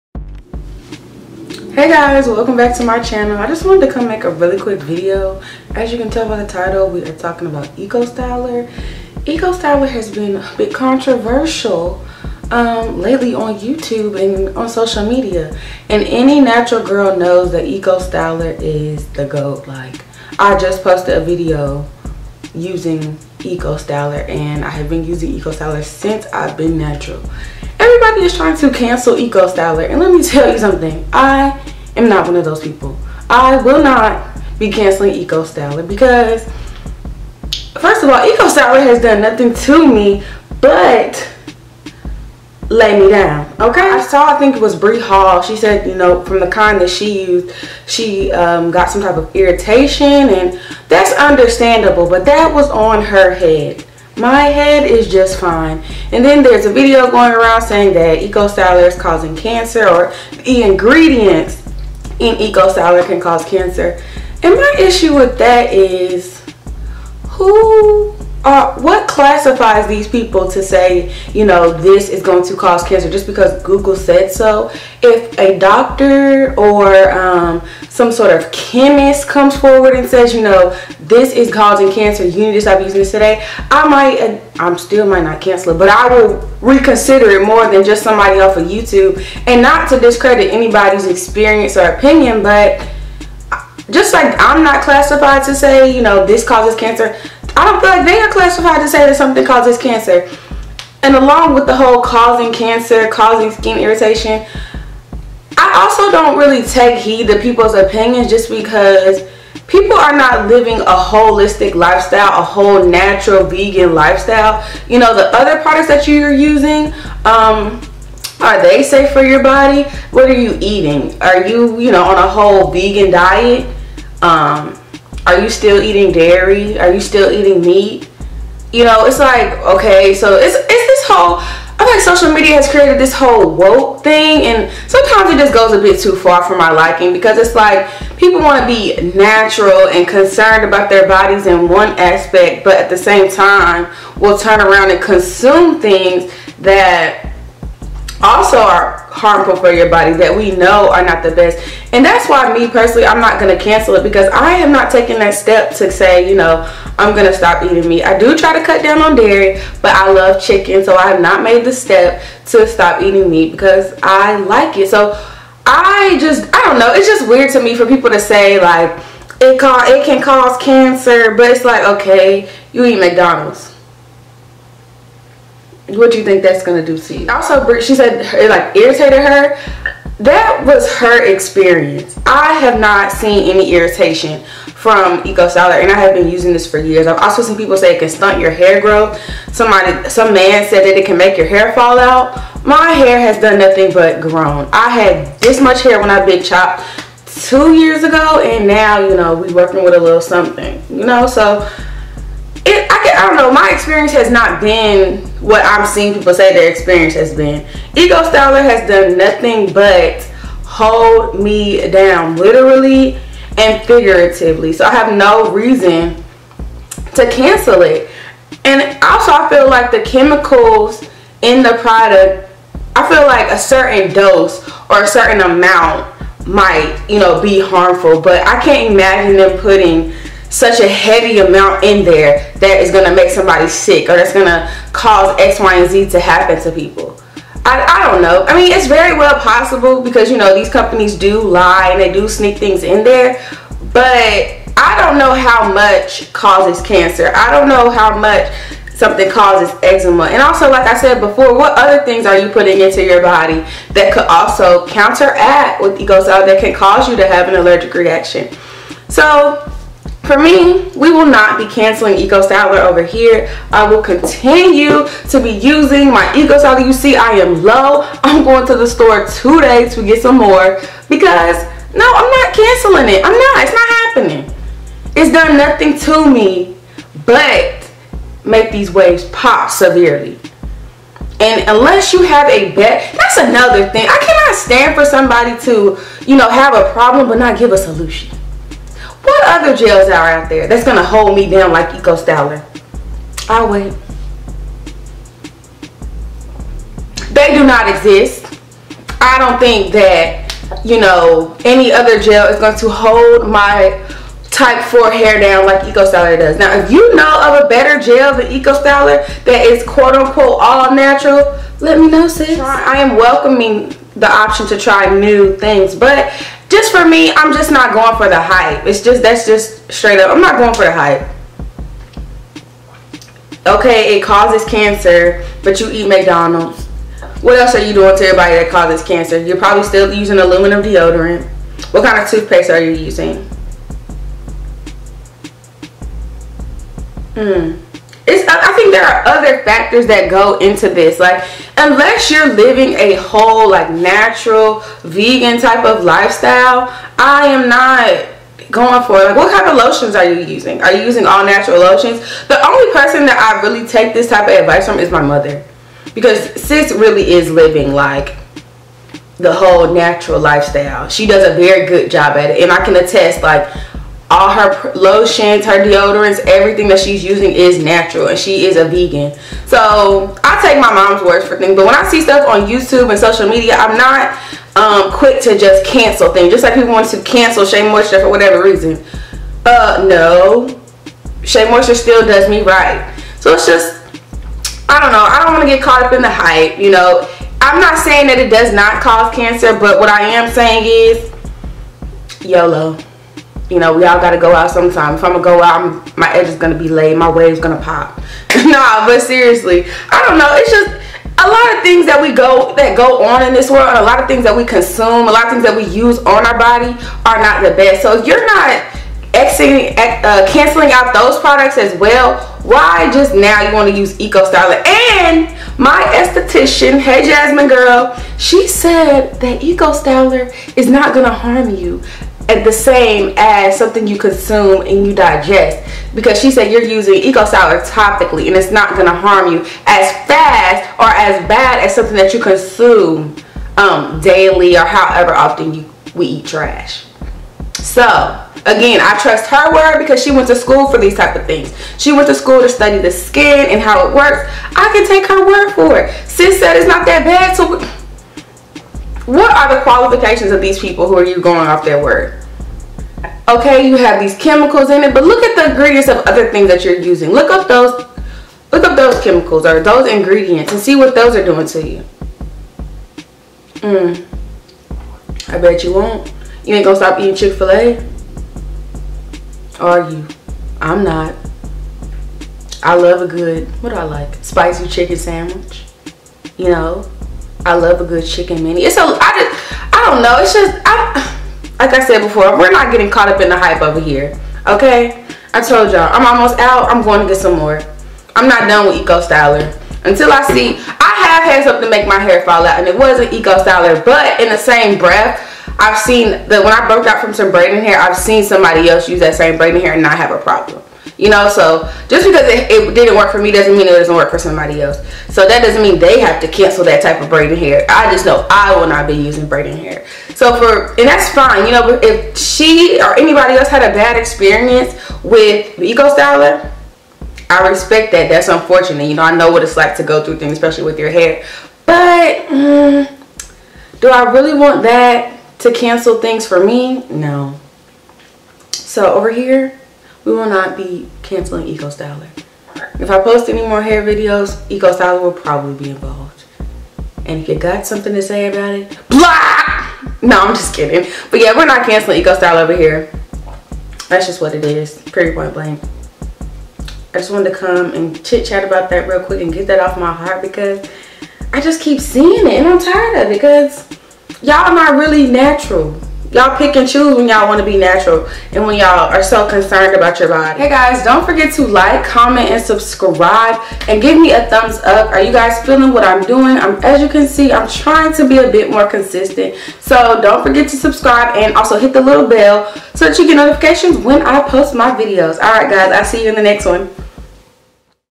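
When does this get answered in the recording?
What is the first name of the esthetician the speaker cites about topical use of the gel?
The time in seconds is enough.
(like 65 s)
417 s.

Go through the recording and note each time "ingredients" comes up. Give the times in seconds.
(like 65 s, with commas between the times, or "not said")
60 s, 455 s, 460 s.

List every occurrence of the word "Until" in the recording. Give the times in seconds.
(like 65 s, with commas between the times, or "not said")
490 s.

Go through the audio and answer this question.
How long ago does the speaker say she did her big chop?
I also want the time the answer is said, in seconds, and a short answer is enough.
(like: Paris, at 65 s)
2 years ago, at 197 s.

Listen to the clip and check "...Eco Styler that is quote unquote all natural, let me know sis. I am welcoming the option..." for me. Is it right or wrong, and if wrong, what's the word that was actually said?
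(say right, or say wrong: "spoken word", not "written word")
right.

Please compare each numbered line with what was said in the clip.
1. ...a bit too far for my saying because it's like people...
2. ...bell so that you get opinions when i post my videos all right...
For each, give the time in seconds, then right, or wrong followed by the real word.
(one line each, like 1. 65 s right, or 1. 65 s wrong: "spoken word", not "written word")
1. 135 s wrong: "liking", not "saying"
2. 572 s wrong: "notifications", not "opinions".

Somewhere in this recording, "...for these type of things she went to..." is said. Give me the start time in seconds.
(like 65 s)
440 s.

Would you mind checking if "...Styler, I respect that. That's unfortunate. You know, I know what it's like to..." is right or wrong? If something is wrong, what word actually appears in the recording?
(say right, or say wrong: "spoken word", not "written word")
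right.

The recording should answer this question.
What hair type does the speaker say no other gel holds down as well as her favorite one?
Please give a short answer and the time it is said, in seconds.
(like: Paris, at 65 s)
type 4, at 304 s.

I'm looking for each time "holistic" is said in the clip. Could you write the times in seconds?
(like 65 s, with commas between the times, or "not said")
110 s.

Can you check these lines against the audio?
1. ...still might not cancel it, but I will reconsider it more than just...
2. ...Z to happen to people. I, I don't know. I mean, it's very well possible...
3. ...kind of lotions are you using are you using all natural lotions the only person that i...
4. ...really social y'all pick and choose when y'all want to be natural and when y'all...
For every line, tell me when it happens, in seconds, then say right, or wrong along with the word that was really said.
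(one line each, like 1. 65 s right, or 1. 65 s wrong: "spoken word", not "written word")
1. 84 s right
2. 235 s right
3. 349 s right
4. 554 s wrong: "natural", not "social".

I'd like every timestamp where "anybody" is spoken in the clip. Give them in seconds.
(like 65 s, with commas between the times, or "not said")
90 s, 513 s.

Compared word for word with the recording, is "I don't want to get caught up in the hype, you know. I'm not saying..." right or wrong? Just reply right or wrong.
right.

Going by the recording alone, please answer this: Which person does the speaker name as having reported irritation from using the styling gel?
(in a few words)
Brie Hall.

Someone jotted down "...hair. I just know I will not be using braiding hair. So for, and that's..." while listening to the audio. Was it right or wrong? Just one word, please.
right.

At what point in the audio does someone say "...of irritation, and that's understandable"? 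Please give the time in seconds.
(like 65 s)
49 s.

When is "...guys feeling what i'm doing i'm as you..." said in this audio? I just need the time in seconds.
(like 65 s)
565 s.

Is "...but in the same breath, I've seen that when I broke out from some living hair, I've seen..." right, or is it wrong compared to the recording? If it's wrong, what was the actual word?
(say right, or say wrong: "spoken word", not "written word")
wrong: "braiding", not "living".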